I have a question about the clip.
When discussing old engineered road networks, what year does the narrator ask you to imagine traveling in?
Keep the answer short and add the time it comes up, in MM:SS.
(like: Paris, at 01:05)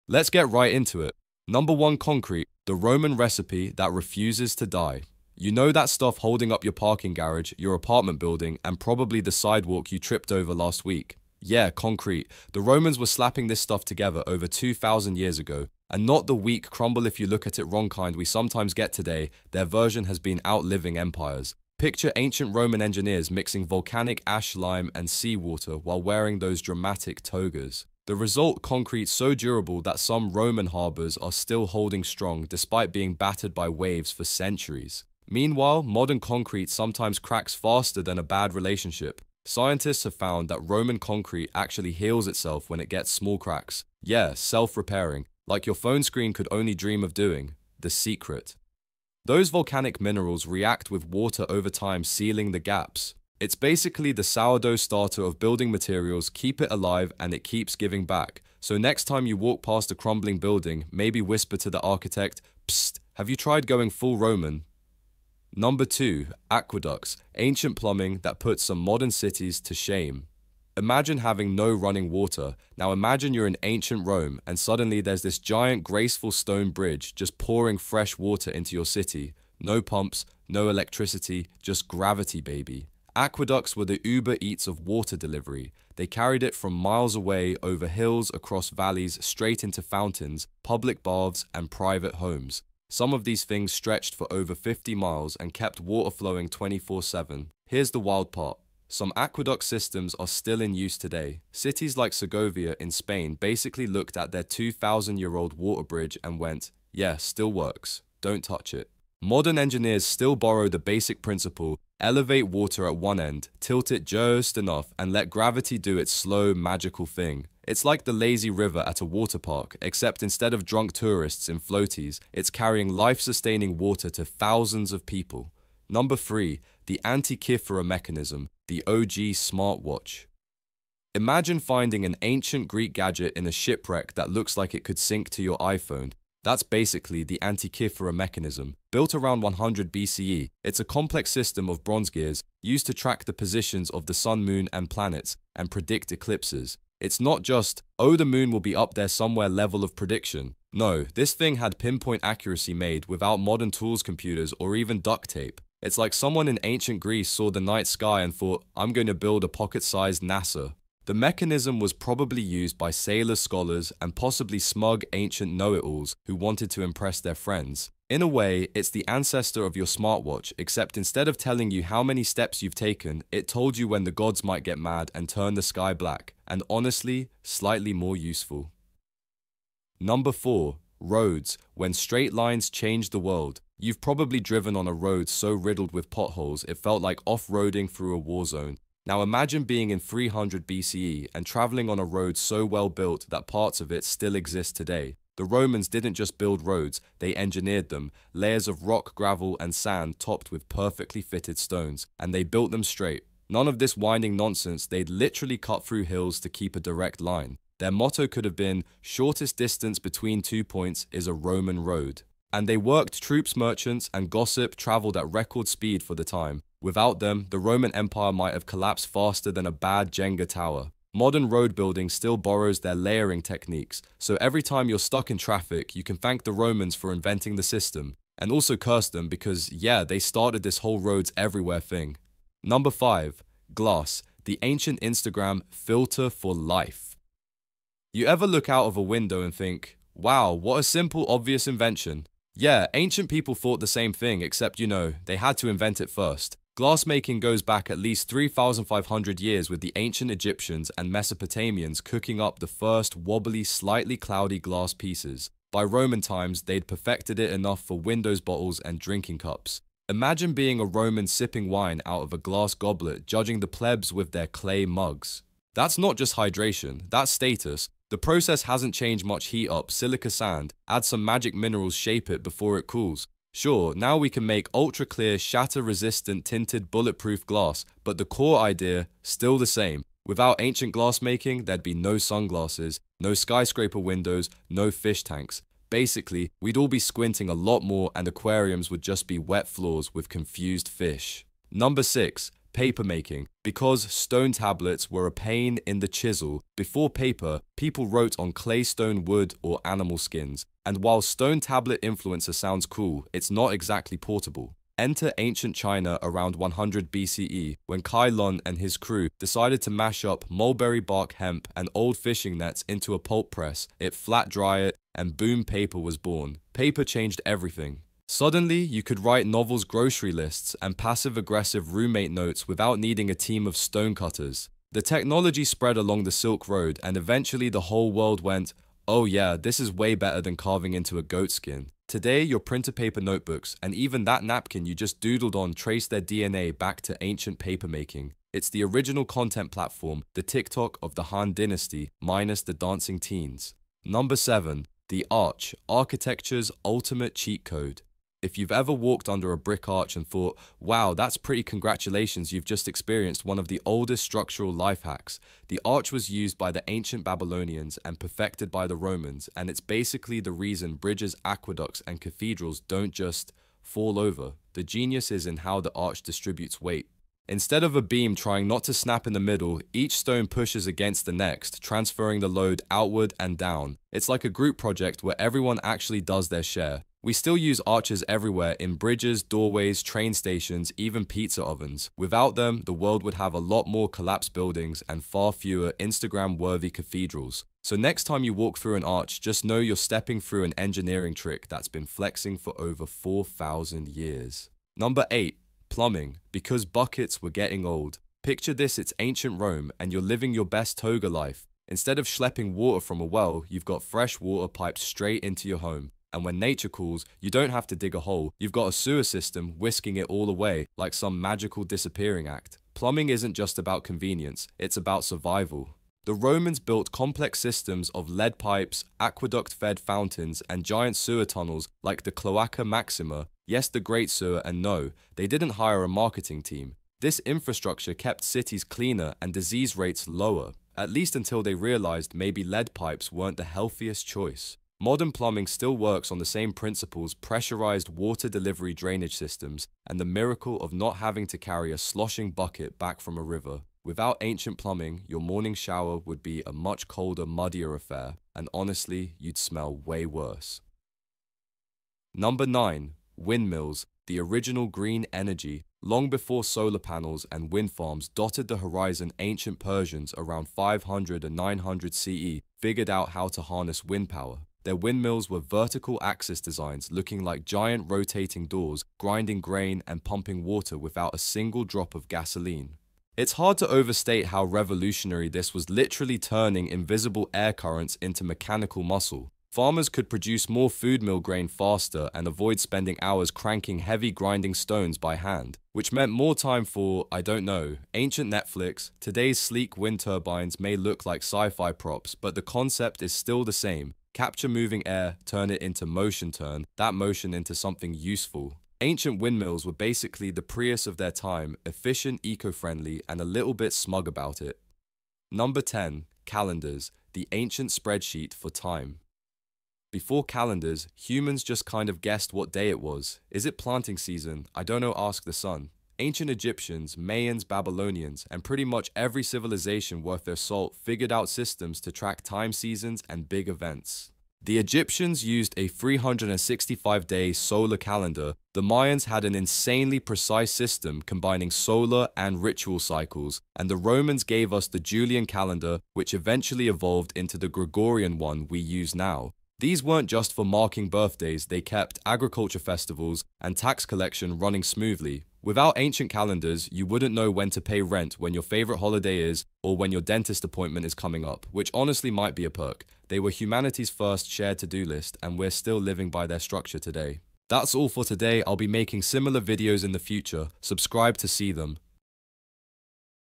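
300 BCE, at 03:09.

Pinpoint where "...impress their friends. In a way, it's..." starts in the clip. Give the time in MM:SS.
02:46.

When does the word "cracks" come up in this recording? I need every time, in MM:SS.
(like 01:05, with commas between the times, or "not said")
00:37, 00:43.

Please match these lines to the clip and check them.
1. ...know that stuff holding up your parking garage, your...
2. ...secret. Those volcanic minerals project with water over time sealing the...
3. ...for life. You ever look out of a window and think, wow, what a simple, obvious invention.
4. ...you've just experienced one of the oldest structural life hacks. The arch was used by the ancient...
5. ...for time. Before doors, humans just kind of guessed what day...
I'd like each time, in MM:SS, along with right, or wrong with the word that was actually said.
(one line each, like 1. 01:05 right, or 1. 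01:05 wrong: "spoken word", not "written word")
1. 00:05 right
2. 00:47 wrong: "react", not "project"
3. 03:56 right
4. 05:52 right
5. 08:28 wrong: "calendars", not "doors".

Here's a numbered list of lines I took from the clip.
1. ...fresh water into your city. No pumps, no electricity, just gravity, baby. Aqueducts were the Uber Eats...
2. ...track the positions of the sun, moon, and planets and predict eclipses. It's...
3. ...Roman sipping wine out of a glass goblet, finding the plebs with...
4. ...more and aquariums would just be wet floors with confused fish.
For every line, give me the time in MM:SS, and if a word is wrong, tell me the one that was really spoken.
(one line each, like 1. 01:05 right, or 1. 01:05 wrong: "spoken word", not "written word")
1. 01:17 right
2. 02:22 right
3. 04:20 wrong: "judging", not "finding"
4. 04:47 right.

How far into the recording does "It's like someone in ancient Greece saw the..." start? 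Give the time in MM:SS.
02:35.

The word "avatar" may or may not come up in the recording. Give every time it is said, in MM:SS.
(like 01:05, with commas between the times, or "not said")
not said.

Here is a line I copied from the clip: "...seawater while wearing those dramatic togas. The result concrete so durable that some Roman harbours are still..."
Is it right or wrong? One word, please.
right.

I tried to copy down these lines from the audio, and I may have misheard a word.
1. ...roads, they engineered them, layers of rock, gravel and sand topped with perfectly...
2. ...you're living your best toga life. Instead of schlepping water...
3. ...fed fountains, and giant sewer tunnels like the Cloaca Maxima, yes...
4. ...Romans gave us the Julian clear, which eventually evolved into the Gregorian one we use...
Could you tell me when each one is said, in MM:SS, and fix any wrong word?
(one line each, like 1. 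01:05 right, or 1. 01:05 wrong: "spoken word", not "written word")
1. 03:16 right
2. 06:40 right
3. 06:59 right
4. 08:54 wrong: "calendar", not "clear".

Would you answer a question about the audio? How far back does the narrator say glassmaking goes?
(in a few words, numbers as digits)
3,500 years.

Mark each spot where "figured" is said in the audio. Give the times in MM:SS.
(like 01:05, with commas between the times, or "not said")
07:42, 08:41.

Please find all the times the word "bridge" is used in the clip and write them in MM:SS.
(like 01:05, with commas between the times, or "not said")
01:16, 01:45, 06:00, 06:18.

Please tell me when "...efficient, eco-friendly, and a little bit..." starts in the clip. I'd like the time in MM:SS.
08:21.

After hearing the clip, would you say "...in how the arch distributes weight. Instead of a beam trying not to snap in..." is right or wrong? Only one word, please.
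right.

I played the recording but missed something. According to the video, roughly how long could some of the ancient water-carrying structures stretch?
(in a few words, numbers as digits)
over 50 miles.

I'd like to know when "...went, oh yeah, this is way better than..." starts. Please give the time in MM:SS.
05:28.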